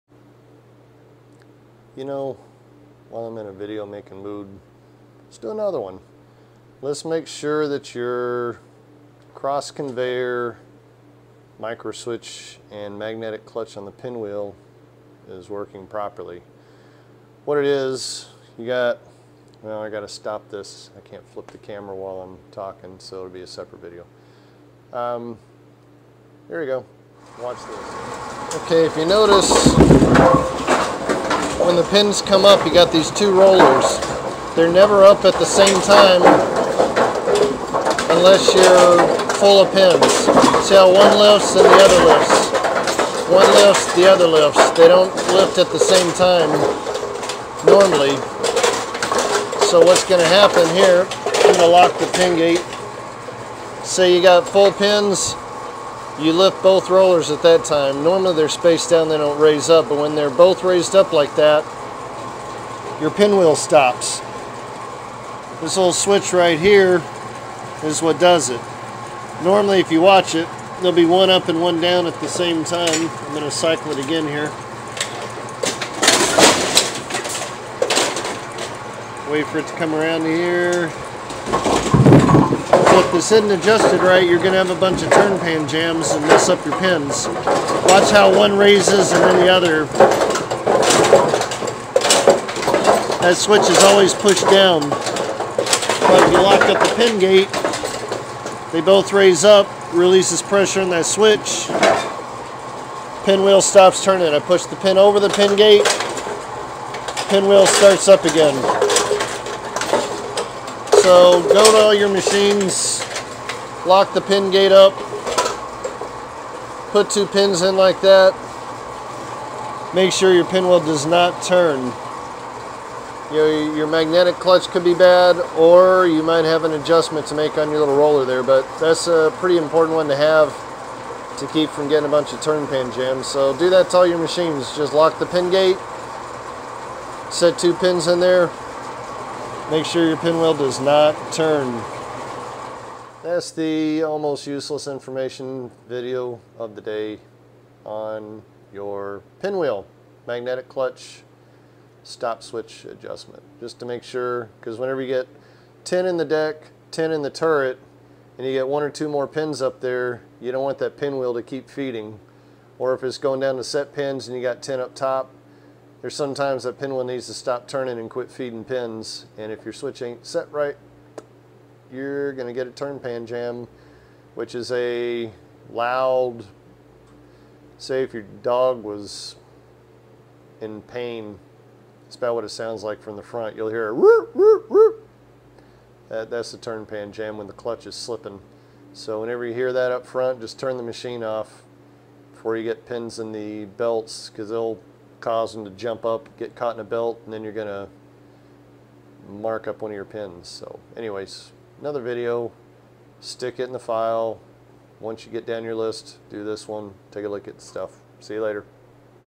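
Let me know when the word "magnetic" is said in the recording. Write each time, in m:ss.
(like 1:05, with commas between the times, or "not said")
0:12, 2:03, 2:30.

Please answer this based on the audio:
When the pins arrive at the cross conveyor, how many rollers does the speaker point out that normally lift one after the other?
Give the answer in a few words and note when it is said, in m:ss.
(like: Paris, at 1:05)
2, at 0:33.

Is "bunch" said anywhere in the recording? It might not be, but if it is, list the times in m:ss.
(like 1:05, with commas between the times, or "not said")
1:24, 2:12.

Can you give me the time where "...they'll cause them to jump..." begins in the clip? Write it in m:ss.
3:14.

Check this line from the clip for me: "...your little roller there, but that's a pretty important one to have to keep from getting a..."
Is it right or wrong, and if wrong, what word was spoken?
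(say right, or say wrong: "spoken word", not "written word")
right.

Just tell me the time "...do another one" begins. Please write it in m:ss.
0:05.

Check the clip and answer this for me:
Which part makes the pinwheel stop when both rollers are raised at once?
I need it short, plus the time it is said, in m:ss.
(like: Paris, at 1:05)
little switch, at 1:05.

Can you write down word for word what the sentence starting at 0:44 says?
They don't lift at the same time normally.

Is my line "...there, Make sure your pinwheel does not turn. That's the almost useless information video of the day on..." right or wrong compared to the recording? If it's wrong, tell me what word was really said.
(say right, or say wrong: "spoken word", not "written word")
right.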